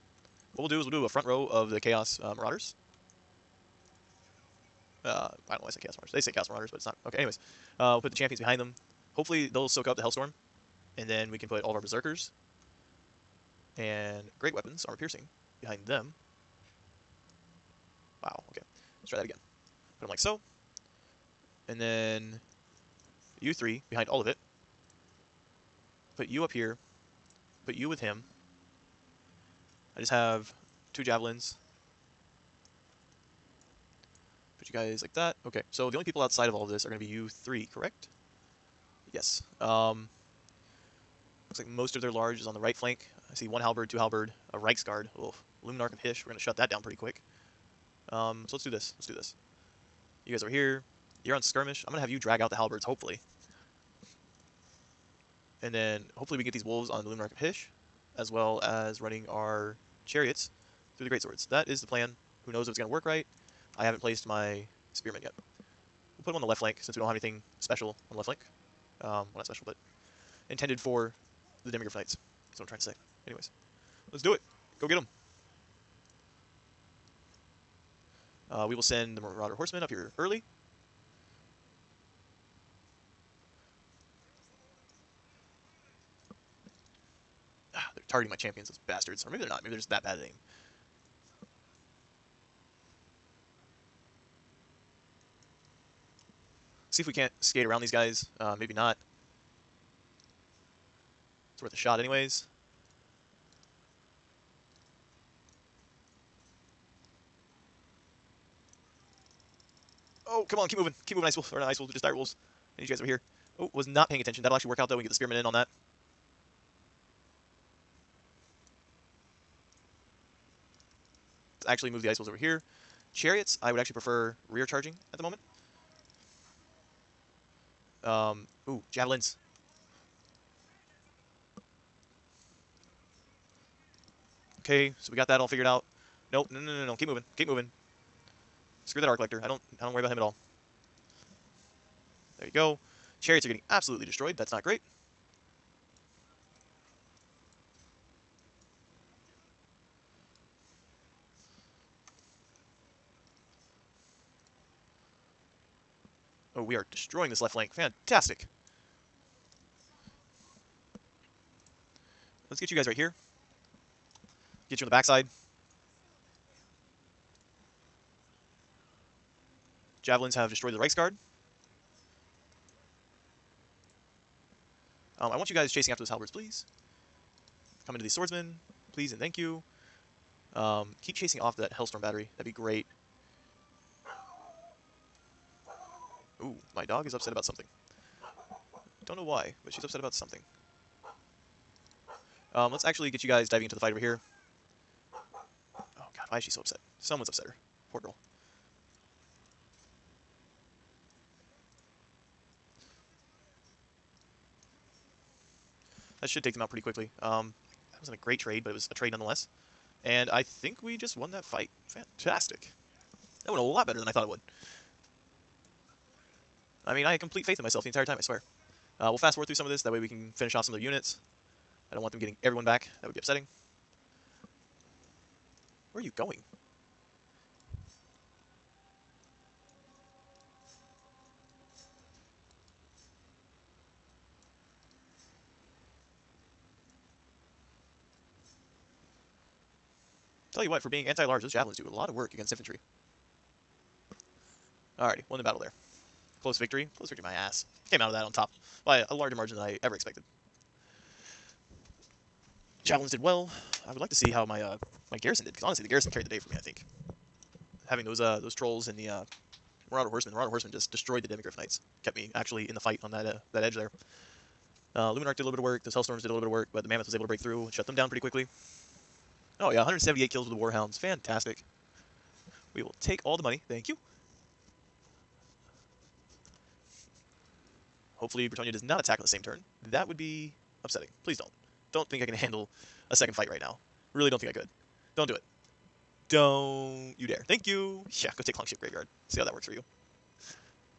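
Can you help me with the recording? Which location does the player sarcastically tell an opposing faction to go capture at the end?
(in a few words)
Longship Graveyard.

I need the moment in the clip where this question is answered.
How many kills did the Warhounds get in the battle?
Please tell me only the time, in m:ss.
4:29.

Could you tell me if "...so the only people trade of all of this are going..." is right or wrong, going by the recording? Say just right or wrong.
wrong.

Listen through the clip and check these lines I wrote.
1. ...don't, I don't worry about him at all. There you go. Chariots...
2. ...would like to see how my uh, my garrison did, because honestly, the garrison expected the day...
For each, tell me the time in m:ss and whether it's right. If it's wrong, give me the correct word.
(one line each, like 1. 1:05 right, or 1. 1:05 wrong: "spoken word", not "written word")
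1. 2:19 right
2. 4:13 wrong: "carried", not "expected".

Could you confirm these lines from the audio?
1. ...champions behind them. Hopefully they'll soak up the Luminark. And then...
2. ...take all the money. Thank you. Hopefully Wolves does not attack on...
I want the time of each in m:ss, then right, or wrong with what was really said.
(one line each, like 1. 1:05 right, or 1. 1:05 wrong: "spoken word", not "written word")
1. 0:08 wrong: "Hellstorm", not "Luminark"
2. 4:33 wrong: "Bretonnia", not "Wolves".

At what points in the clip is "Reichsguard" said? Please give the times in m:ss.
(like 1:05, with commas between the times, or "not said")
0:44, 2:50.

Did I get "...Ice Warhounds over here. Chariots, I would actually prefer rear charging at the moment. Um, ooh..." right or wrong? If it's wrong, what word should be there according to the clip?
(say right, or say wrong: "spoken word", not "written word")
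wrong: "Wolves", not "Warhounds".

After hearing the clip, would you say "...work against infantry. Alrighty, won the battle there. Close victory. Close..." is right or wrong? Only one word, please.
right.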